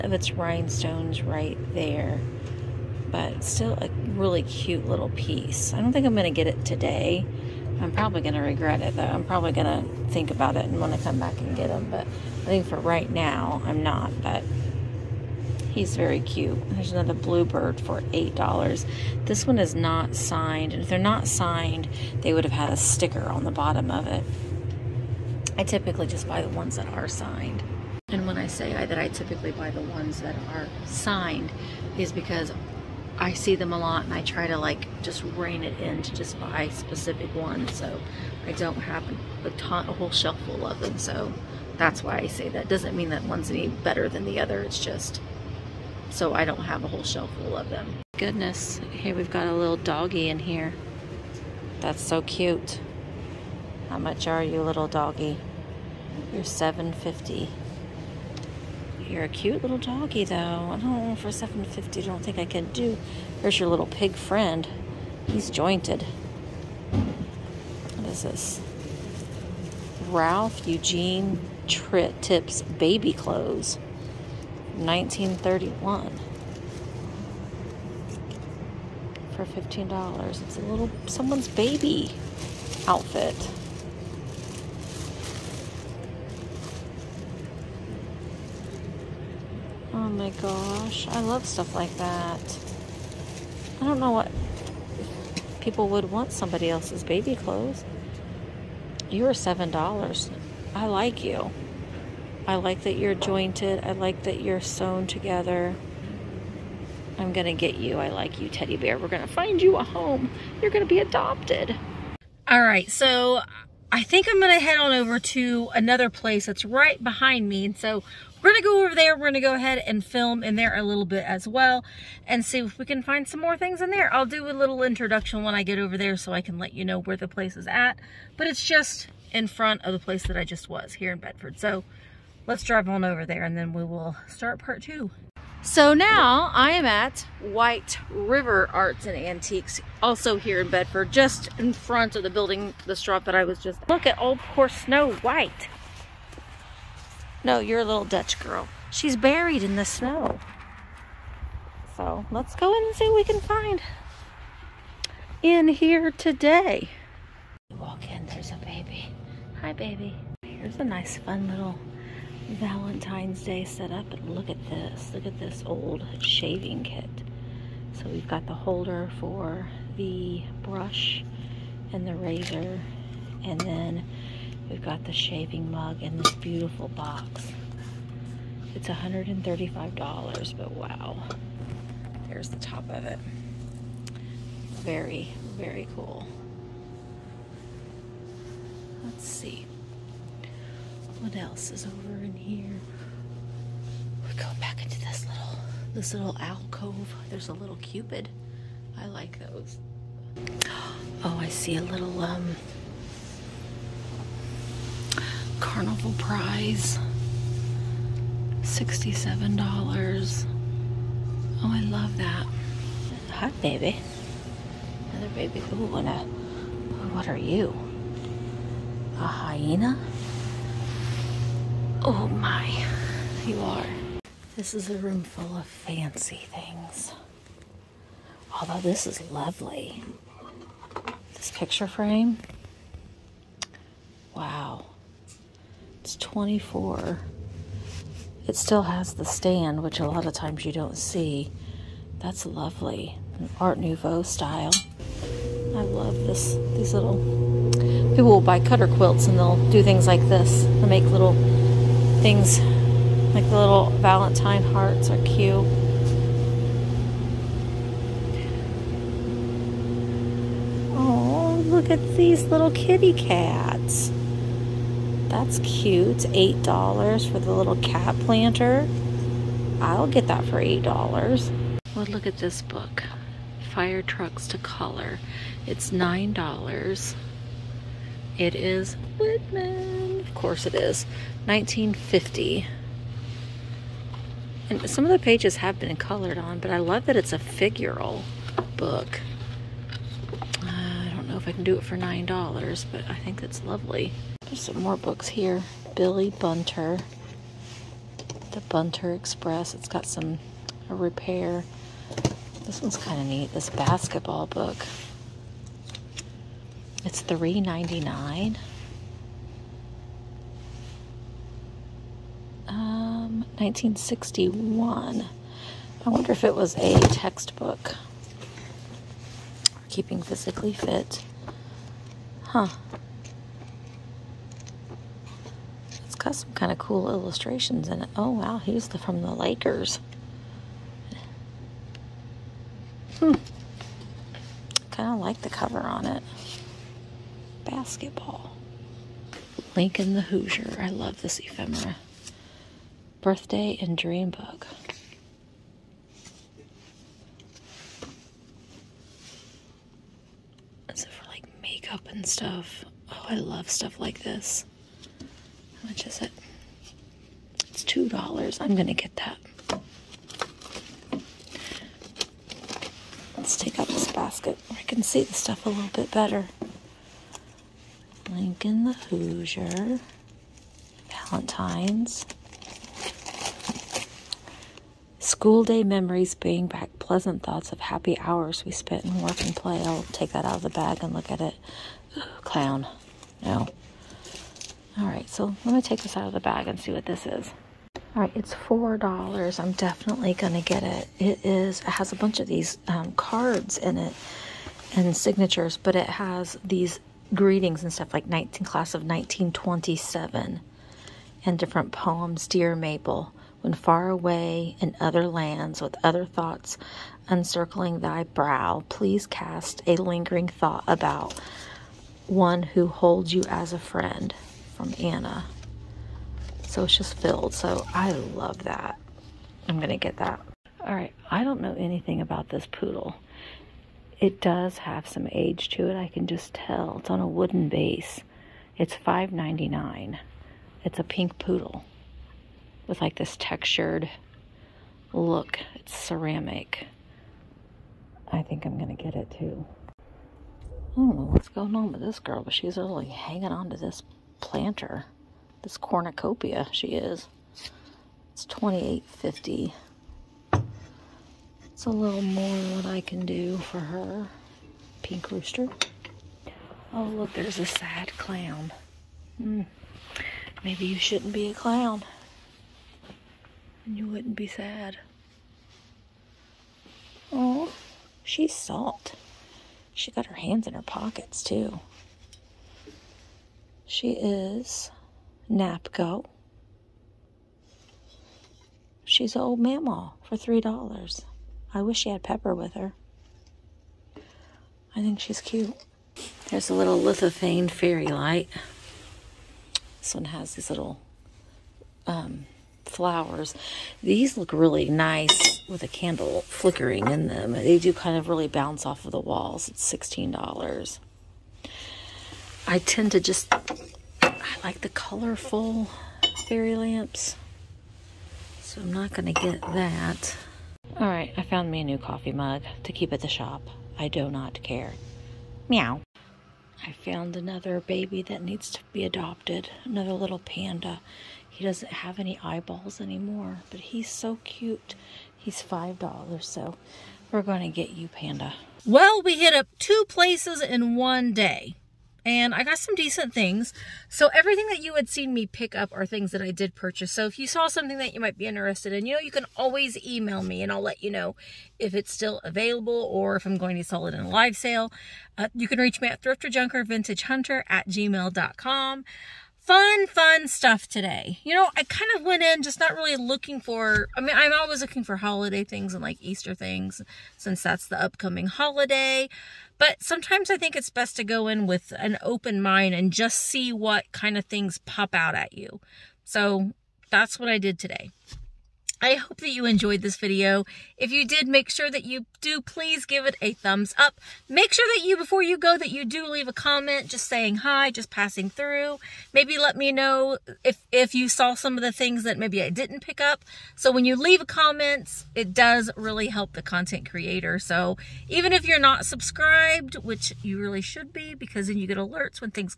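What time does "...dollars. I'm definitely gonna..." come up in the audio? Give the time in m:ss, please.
6:28.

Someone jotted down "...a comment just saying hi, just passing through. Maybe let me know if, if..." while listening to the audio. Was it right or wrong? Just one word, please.
right.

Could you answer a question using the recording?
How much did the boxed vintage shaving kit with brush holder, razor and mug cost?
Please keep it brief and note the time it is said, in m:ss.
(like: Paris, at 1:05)
$135, at 2:58.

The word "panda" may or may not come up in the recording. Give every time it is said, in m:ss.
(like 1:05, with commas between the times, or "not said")
8:40, 8:48.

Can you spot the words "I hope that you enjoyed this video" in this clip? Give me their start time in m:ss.
9:29.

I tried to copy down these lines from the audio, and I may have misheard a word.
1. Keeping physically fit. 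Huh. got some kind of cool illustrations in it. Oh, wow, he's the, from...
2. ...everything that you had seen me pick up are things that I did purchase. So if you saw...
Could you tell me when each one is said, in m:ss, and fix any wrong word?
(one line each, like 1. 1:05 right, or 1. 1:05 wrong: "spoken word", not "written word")
1. 5:19 right
2. 8:54 right.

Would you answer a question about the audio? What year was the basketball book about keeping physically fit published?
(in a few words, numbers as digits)
1961.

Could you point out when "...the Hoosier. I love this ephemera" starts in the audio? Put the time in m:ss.
5:40.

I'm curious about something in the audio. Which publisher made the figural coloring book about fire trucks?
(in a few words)
Whitman.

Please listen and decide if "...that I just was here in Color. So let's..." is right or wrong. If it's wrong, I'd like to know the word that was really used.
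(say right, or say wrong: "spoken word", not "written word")
wrong: "Bedford", not "Color".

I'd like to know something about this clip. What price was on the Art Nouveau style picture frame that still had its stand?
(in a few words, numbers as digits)
24.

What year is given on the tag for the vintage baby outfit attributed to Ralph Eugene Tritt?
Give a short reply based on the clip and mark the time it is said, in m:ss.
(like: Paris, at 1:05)
1931, at 1:14.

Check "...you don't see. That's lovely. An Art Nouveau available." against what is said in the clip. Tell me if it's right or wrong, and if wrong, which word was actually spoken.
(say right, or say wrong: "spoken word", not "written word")
wrong: "style", not "available".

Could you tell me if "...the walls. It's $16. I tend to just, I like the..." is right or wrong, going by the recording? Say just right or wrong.
right.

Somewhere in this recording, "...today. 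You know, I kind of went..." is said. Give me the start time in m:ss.
9:10.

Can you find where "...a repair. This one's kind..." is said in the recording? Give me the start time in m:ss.
5:00.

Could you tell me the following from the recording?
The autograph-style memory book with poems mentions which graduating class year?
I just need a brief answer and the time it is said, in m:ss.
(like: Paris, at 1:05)
1927, at 6:38.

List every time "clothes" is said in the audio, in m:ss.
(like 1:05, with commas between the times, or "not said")
1:13, 1:37.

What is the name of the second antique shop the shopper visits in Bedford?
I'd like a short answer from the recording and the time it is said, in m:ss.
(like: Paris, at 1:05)
White River Arts and Antiques, at 2:17.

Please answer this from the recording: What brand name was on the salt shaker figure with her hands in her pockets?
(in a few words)
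NAPCO.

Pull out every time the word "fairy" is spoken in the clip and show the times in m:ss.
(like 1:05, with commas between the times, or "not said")
8:07, 8:26.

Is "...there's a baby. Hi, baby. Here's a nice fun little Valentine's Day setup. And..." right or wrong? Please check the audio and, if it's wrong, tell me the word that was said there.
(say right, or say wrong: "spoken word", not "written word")
right.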